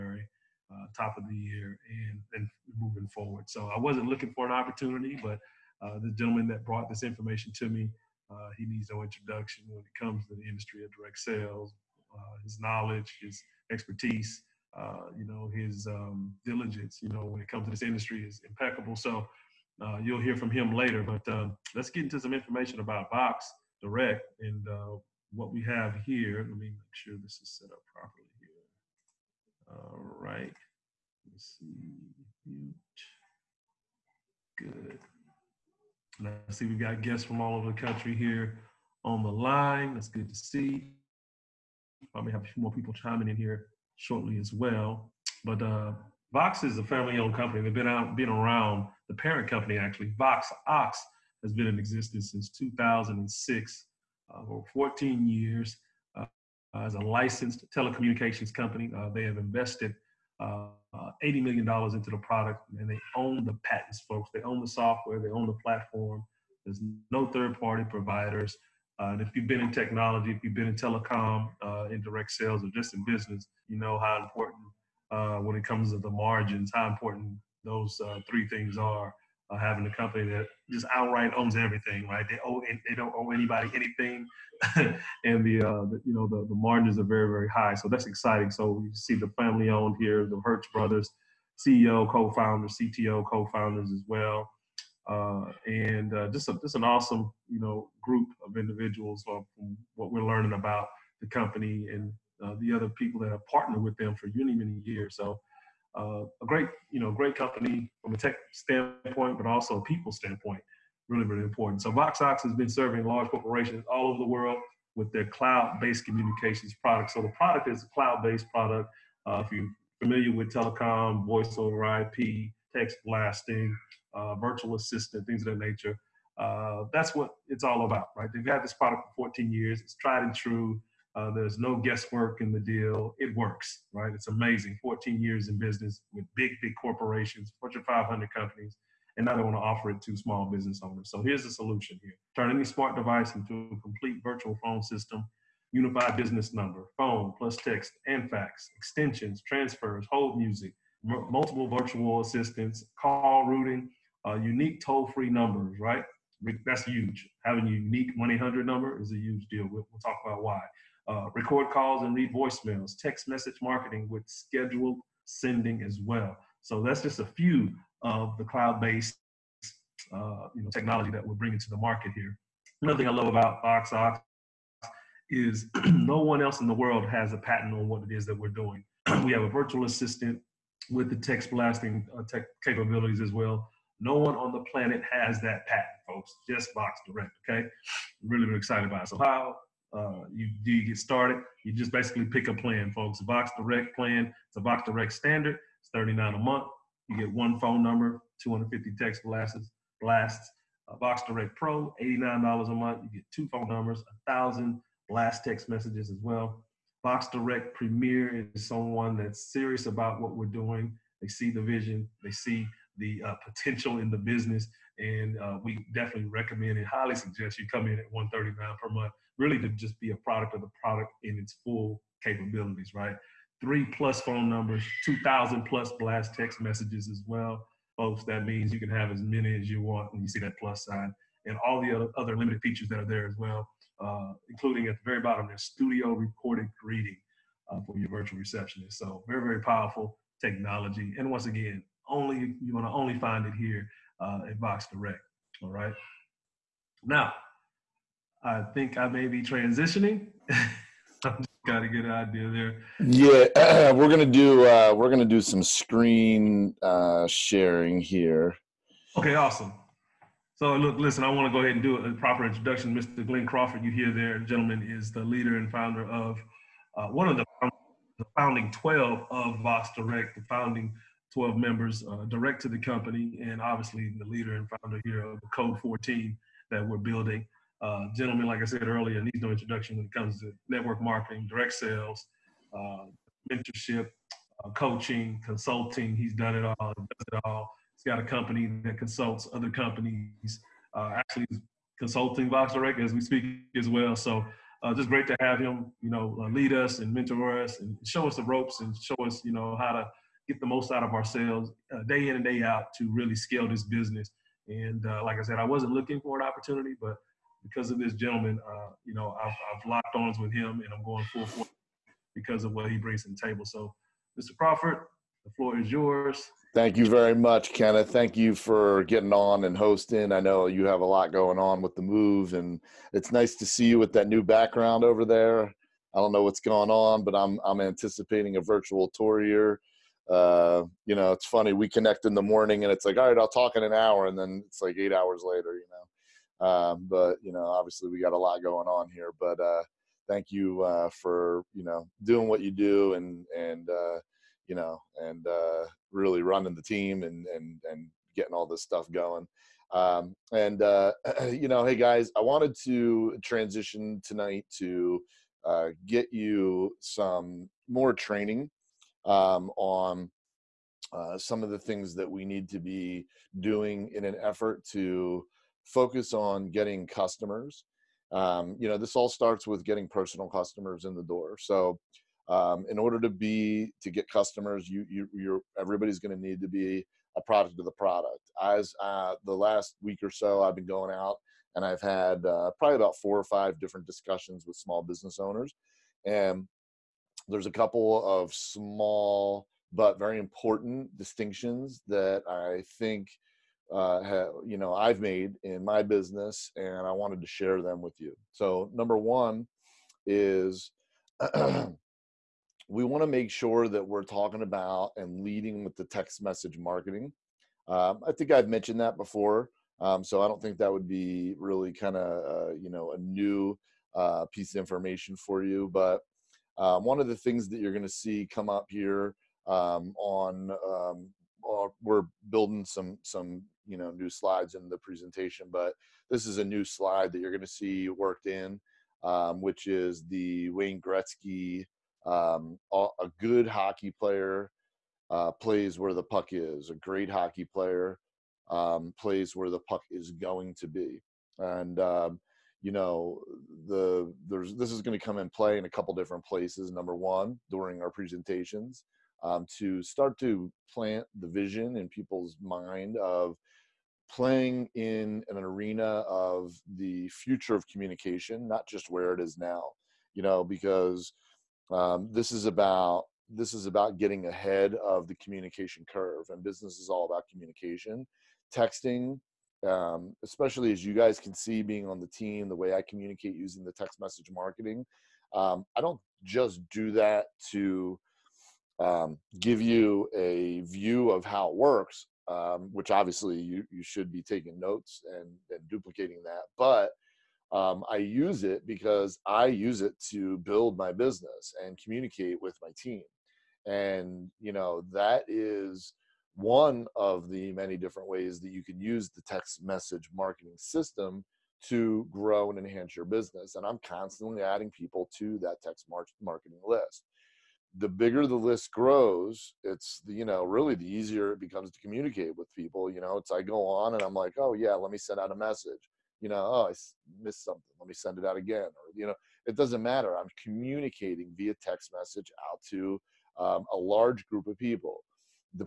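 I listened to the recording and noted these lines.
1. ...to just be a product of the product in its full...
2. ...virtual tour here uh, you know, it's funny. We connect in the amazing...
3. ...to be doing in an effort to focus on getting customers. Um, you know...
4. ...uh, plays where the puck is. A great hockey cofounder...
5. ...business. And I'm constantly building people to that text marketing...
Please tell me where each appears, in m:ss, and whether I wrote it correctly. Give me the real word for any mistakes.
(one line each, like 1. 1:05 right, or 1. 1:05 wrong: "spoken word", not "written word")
1. 3:39 right
2. 5:28 wrong: "morning", not "amazing"
3. 6:02 right
4. 7:15 wrong: "player", not "cofounder"
5. 8:23 wrong: "adding", not "building".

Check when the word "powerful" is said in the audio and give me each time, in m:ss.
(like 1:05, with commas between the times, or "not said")
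3:59.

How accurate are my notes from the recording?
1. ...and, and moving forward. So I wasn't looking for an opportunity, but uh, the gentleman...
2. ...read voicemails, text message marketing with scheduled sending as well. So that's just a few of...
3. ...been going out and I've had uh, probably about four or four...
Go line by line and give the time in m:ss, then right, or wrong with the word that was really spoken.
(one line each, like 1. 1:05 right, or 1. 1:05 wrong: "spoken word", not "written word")
1. 0:02 right
2. 2:42 right
3. 6:20 wrong: "five", not "four".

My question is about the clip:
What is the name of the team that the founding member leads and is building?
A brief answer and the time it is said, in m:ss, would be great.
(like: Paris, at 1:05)
Code 4 Team, at 4:35.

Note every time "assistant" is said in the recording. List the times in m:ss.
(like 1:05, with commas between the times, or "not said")
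2:04, 2:32, 2:59.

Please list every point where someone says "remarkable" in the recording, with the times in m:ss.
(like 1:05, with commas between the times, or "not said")
not said.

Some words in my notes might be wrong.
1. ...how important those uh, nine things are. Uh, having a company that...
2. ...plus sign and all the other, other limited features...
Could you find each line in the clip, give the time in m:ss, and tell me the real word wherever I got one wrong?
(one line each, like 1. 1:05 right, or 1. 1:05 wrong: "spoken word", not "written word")
1. 1:16 wrong: "three", not "nine"
2. 3:50 right.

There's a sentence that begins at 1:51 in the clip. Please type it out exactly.
So VoxOx has been serving large corporations all over the world with their cloud-based communications product.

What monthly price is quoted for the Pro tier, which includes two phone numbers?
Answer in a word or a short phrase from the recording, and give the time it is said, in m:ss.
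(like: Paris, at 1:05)
$89, at 3:22.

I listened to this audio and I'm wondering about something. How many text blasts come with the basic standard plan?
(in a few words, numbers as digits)
250.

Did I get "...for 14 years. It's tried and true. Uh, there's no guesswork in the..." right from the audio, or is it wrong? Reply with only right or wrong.
right.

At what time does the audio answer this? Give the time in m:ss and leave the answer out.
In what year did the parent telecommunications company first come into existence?
0:52.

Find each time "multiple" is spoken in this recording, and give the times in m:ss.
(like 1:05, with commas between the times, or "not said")
2:31.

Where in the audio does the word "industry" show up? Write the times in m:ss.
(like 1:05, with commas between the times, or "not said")
0:10, 0:17.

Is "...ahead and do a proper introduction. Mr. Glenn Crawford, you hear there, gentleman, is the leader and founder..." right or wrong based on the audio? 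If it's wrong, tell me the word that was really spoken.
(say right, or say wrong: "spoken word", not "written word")
right.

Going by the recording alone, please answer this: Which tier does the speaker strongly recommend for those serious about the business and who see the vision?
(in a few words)
Vox Direct Premier.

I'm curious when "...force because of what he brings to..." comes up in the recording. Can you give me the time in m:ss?
5:11.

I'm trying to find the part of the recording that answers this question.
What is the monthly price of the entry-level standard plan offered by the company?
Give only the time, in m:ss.
3:15.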